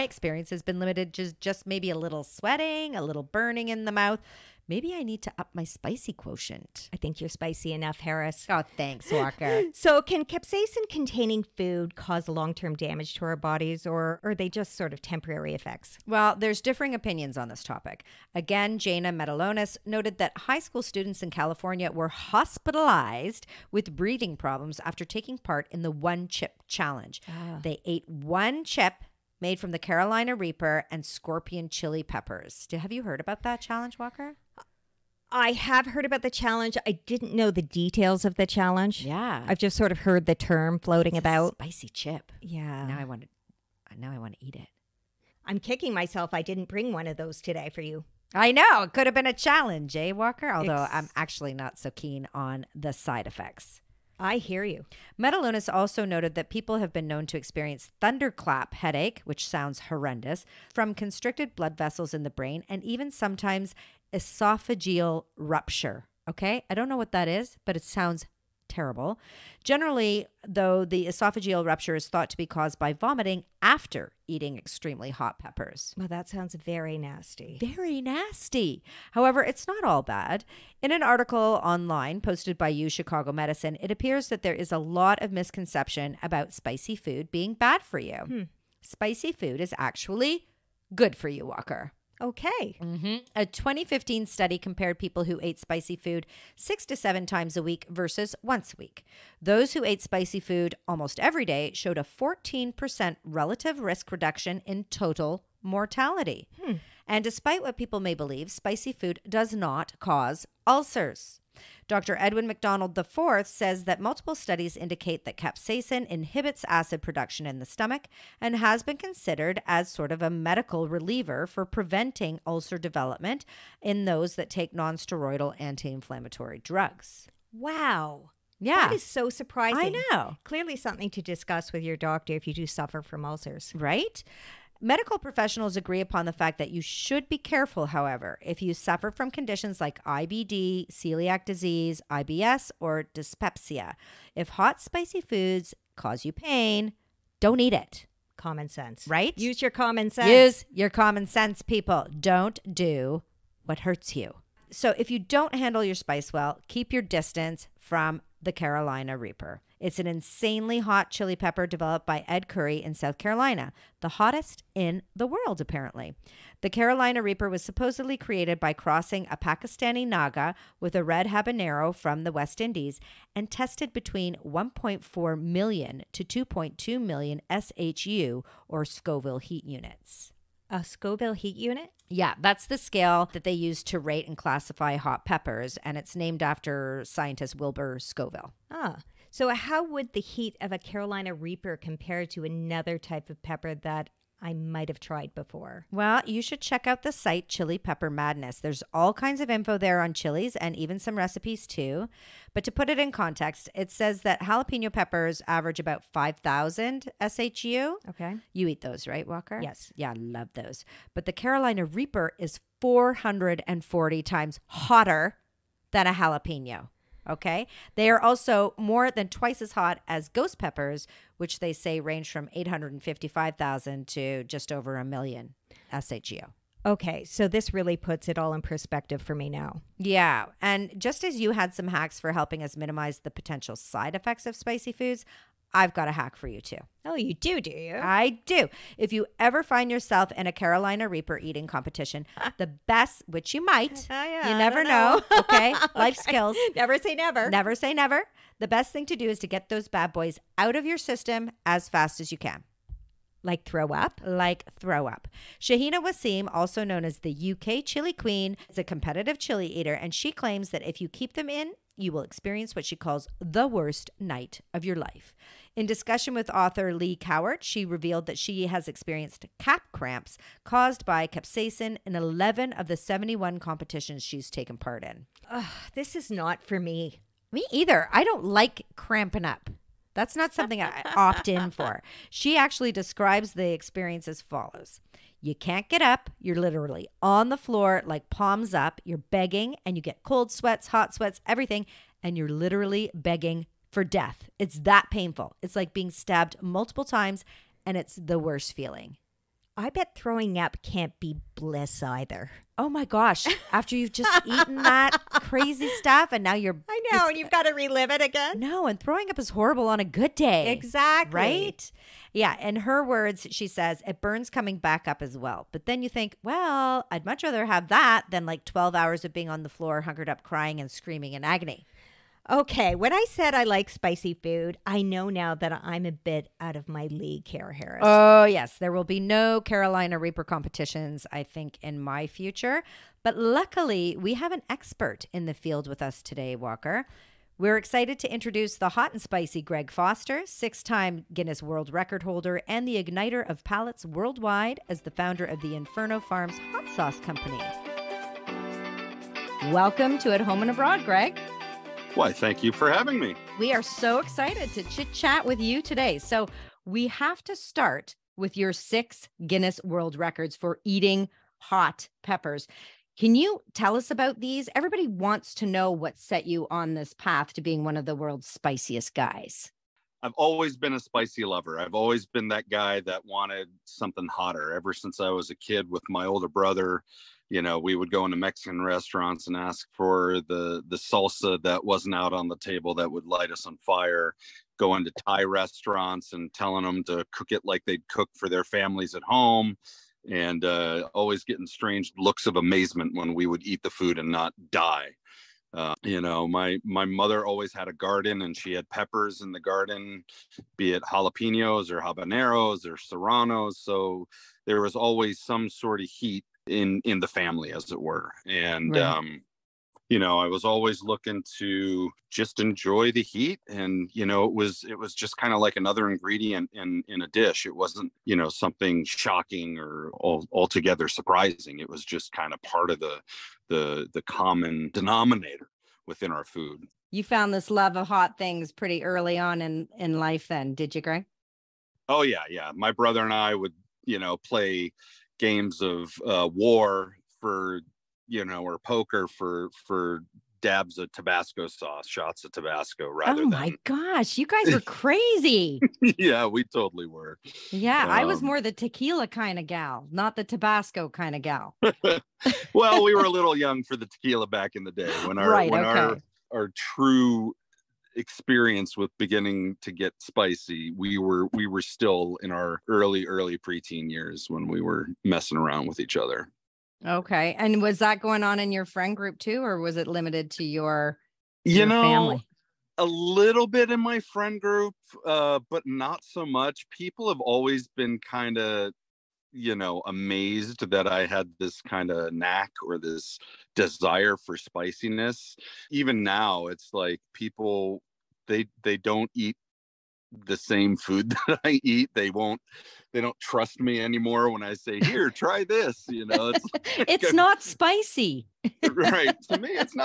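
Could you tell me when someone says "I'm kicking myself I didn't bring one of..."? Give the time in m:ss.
0:45.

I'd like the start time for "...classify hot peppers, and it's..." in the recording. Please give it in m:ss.
3:04.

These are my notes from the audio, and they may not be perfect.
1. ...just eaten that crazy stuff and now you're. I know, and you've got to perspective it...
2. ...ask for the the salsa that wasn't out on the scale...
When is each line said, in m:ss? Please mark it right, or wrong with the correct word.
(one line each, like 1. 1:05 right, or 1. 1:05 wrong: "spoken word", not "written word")
1. 5:04 wrong: "relive", not "perspective"
2. 6:19 wrong: "table", not "scale".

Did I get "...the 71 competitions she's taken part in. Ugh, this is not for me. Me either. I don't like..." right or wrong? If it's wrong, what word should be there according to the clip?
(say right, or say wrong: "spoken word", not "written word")
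right.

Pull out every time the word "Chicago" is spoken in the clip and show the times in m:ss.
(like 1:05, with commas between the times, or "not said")
1:22.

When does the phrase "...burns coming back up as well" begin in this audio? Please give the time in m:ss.
5:14.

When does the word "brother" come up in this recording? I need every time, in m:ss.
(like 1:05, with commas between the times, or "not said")
6:16, 7:12.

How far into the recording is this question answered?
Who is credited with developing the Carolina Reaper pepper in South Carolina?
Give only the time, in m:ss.
2:42.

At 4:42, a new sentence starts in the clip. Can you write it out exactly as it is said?
She actually describes the experience as follows You can't get up.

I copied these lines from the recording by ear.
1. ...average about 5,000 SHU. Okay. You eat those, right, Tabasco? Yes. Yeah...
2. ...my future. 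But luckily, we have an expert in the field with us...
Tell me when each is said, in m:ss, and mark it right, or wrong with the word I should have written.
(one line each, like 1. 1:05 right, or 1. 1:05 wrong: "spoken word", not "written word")
1. 3:25 wrong: "Walker", not "Tabasco"
2. 5:31 right.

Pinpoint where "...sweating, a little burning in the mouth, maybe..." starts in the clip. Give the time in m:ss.
0:02.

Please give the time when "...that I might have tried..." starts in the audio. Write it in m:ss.
3:13.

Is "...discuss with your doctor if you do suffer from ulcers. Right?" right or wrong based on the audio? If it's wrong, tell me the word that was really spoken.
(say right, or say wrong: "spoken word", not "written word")
right.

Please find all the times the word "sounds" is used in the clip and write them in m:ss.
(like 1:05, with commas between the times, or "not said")
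0:59, 1:07, 1:16.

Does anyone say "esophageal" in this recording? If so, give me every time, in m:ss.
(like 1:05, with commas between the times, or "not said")
1:04, 1:11.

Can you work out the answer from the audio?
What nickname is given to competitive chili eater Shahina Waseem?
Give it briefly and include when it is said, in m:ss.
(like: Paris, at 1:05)
UK Chili Queen, at 4:17.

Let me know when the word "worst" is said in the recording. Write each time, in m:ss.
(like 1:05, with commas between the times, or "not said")
4:23, 4:58.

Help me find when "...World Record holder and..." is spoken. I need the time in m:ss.
5:41.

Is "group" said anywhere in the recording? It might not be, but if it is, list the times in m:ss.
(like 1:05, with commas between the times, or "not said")
7:49, 7:54.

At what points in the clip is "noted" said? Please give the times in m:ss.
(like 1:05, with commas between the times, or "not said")
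0:19, 0:56.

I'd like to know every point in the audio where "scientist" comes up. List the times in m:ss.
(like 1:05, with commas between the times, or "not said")
3:07.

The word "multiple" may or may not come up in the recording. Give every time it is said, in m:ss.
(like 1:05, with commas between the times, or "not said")
1:54, 4:56.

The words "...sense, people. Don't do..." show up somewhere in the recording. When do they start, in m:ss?
2:31.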